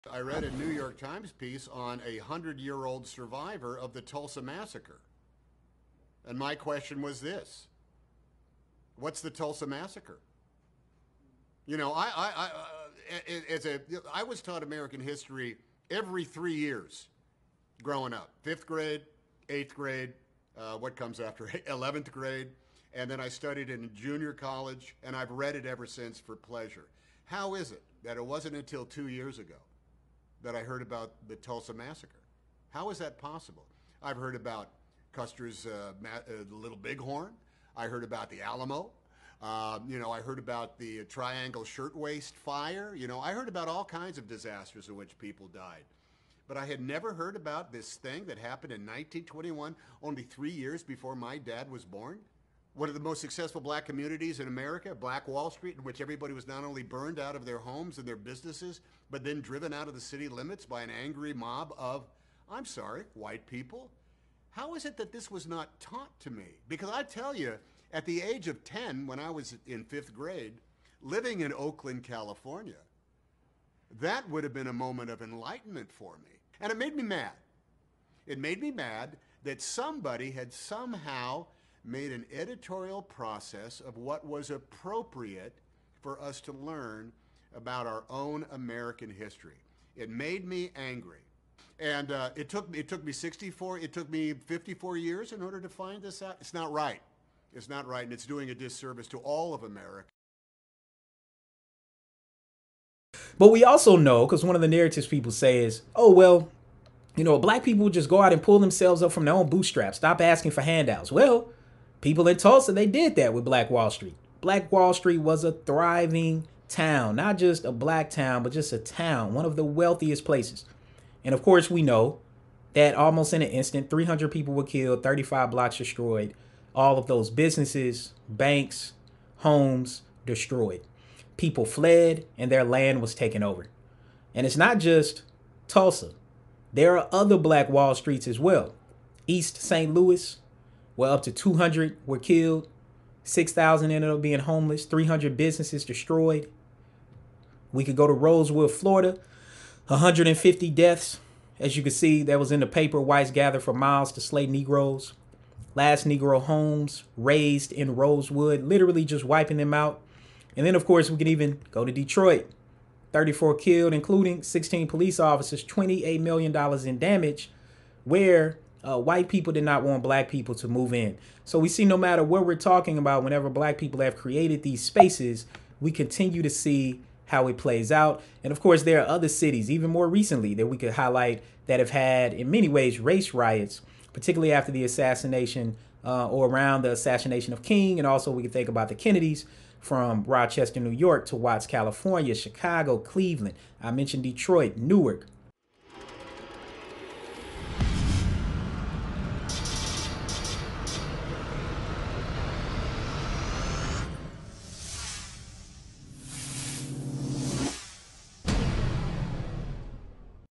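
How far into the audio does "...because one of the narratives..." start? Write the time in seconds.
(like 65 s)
104 s.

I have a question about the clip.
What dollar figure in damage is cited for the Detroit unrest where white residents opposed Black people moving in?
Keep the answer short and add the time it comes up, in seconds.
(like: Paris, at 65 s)
$28 million, at 165 s.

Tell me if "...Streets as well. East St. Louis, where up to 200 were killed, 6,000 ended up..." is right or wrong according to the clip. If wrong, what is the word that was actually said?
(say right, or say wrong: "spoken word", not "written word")
right.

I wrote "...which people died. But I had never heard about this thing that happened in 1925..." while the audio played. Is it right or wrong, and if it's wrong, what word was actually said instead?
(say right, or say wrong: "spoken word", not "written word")
wrong: "1921", not "1925".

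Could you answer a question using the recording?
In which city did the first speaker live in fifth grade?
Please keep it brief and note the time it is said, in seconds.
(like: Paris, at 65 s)
Oakland, California, at 71 s.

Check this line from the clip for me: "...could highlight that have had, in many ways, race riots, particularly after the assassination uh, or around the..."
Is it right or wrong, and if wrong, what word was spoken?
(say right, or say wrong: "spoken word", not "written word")
right.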